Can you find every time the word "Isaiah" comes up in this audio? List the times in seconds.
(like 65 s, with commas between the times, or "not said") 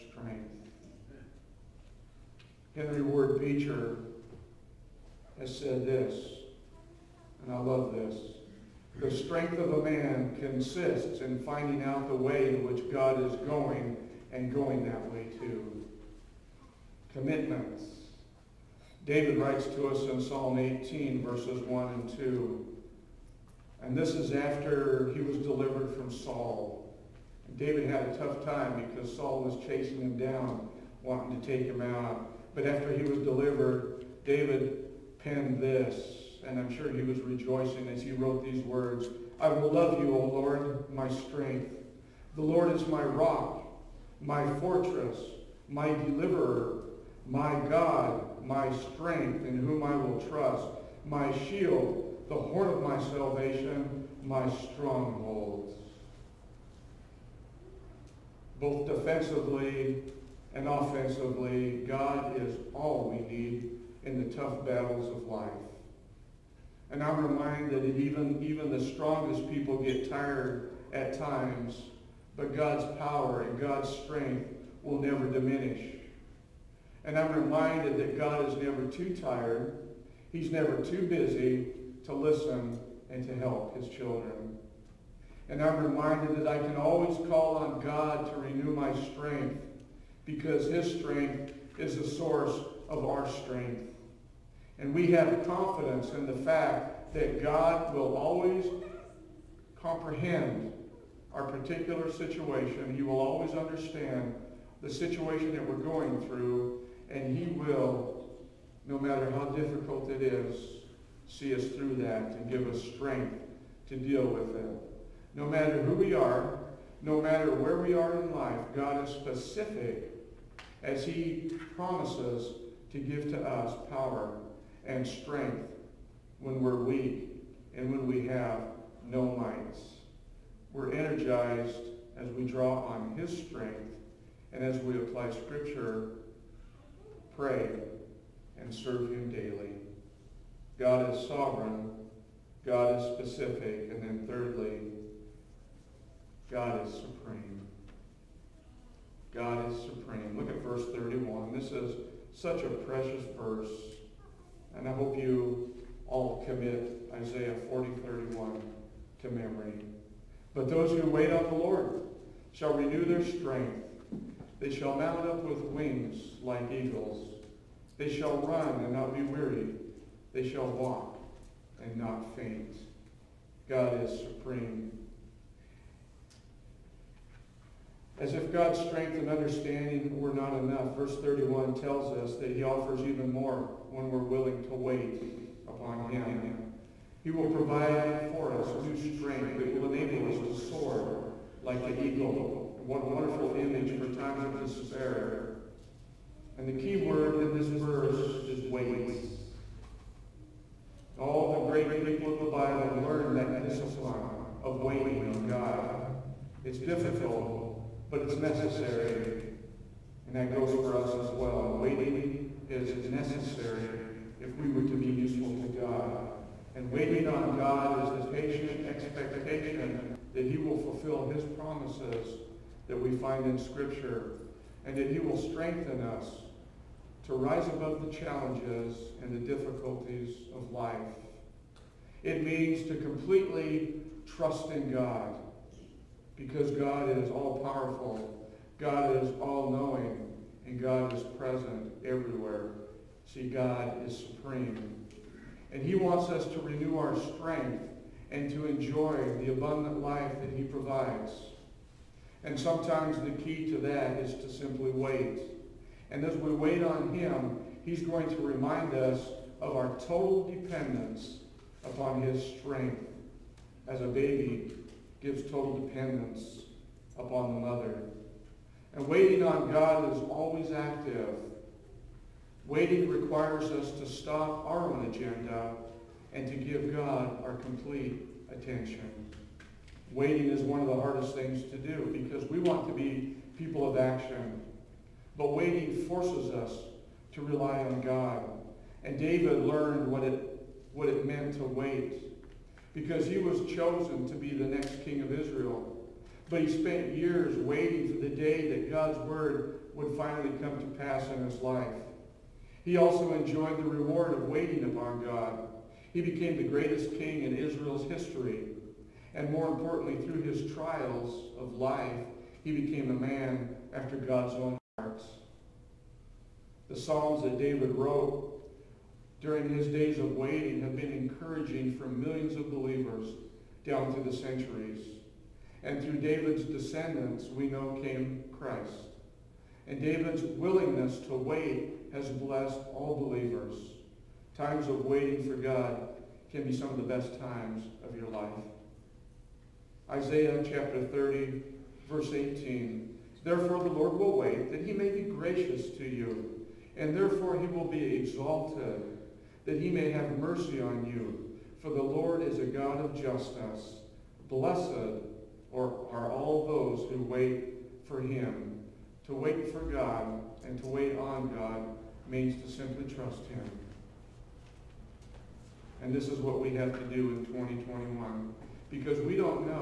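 157 s, 340 s.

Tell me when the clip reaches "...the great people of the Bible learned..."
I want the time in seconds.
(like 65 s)
201 s.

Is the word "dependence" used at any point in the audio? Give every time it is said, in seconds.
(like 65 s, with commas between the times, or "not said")
260 s, 265 s.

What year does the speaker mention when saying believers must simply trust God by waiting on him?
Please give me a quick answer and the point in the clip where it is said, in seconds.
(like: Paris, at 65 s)
2021, at 367 s.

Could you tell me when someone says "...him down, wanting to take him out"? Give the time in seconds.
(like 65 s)
30 s.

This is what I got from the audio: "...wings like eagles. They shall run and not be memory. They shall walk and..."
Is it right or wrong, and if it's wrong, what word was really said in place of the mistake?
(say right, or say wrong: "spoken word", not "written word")
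wrong: "weary", not "memory".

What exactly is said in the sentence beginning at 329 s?
And David's willingness to wait has blessed all believers.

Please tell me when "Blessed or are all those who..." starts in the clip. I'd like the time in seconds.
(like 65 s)
354 s.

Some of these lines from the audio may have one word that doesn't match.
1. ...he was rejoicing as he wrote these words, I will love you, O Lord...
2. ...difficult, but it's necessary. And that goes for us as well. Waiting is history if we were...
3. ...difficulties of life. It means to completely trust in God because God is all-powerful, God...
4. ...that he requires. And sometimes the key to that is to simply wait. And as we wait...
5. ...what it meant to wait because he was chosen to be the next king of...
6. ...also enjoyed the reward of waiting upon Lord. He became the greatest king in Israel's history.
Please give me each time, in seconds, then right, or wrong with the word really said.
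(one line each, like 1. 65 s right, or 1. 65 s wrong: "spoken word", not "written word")
1. 36 s right
2. 206 s wrong: "necessary", not "history"
3. 229 s right
4. 250 s wrong: "provides", not "requires"
5. 290 s right
6. 302 s wrong: "God", not "Lord".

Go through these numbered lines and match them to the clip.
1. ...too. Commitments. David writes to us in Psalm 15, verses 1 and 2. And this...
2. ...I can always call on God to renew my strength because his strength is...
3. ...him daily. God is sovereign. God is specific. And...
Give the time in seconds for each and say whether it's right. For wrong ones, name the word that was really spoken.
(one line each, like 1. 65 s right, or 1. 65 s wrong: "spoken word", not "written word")
1. 15 s wrong: "18", not "15"
2. 86 s right
3. 139 s right.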